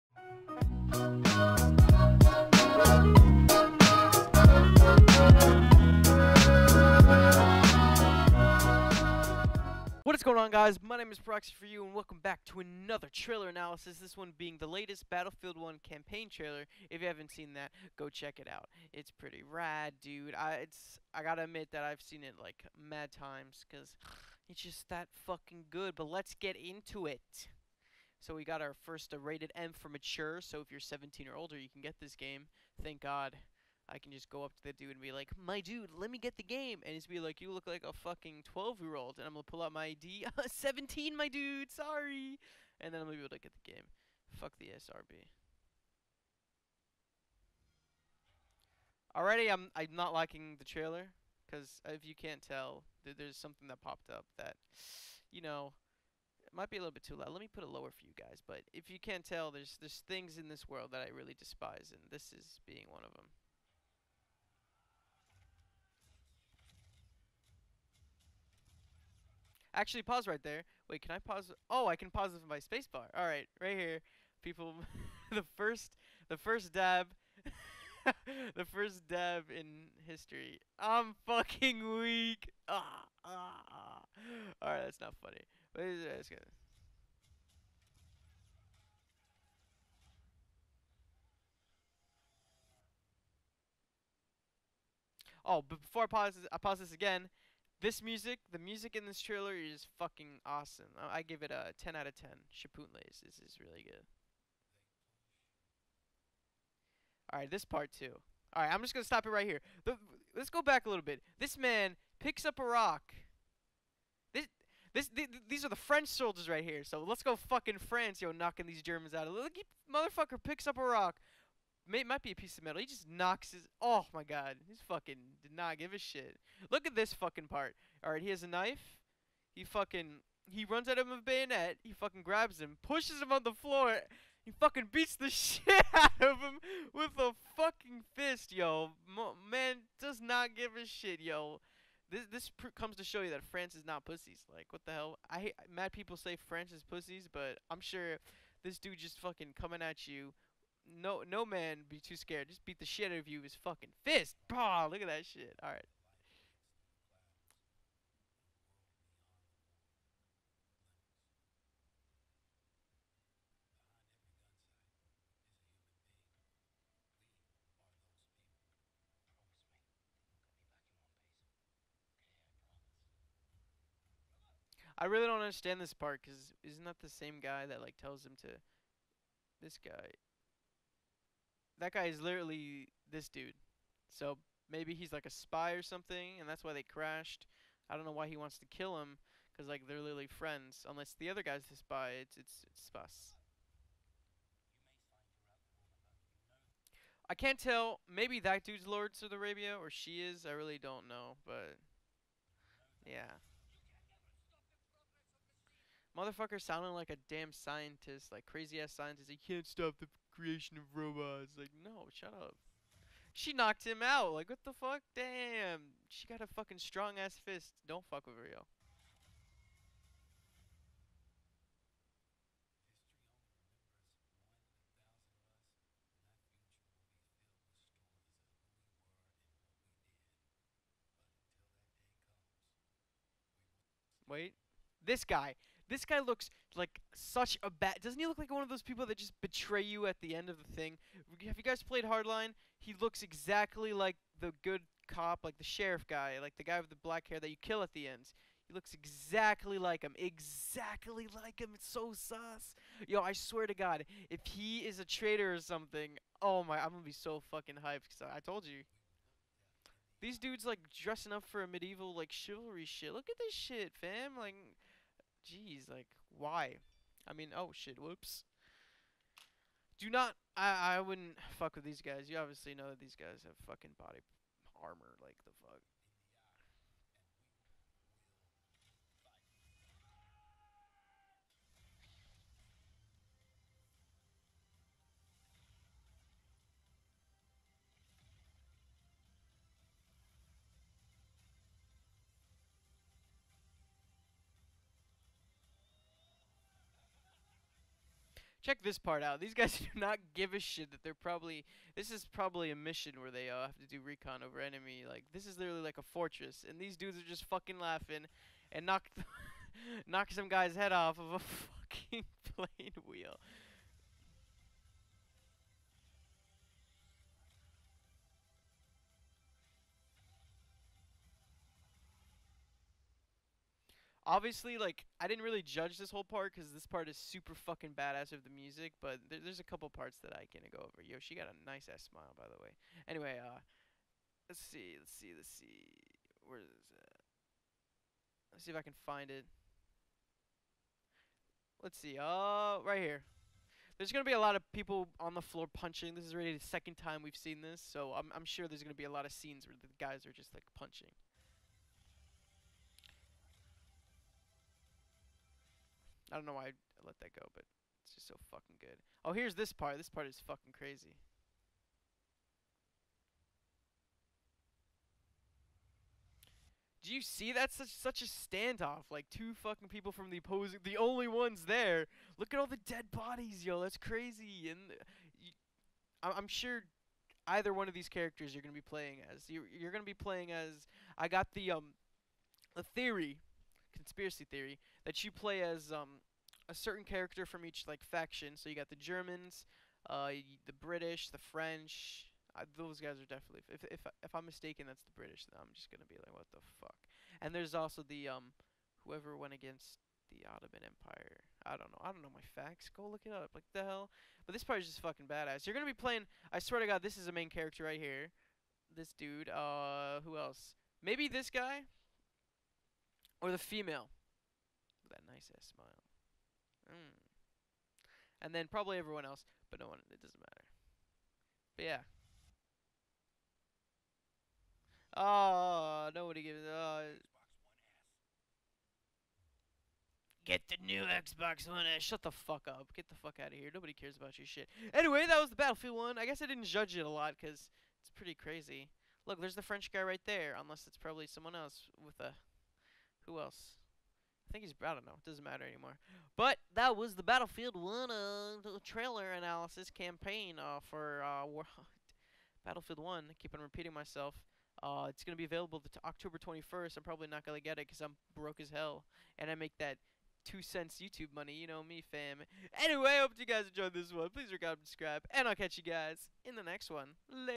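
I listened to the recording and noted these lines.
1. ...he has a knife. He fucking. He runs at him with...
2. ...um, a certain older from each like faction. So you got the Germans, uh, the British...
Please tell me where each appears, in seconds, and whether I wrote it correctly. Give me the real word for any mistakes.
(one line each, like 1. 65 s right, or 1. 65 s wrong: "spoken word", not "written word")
1. 128 s right
2. 385 s wrong: "character", not "older".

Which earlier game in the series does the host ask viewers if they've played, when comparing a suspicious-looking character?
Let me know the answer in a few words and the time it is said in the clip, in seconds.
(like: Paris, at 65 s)
Hardline, at 242 s.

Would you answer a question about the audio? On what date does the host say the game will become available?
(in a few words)
October 21st.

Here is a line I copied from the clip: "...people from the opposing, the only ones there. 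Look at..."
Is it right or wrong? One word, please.
right.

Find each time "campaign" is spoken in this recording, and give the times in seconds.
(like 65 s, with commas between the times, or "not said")
15 s, 449 s.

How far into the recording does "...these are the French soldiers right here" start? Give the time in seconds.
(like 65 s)
115 s.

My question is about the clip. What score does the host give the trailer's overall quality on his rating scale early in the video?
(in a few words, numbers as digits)
10 out of 10.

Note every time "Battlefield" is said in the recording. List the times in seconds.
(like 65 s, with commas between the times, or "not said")
15 s, 435 s, 447 s, 452 s.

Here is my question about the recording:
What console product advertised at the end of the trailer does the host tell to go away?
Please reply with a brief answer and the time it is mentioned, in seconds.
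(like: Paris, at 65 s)
Xbox One S, at 431 s.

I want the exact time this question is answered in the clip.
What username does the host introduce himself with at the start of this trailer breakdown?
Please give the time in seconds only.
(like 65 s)
11 s.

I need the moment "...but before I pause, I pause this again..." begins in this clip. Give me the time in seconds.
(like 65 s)
95 s.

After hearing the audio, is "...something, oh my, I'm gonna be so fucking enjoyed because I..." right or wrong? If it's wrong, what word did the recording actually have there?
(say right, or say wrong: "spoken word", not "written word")
wrong: "hyped", not "enjoyed".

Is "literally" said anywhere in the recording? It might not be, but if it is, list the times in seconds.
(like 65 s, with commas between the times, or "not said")
182 s, 189 s, 305 s.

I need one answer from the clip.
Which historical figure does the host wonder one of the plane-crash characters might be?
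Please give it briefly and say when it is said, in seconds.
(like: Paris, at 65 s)
Lawrence of Arabia, at 198 s.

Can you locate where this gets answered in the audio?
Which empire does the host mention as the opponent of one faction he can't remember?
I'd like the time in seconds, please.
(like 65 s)
400 s.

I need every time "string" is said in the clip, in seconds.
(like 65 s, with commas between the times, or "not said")
not said.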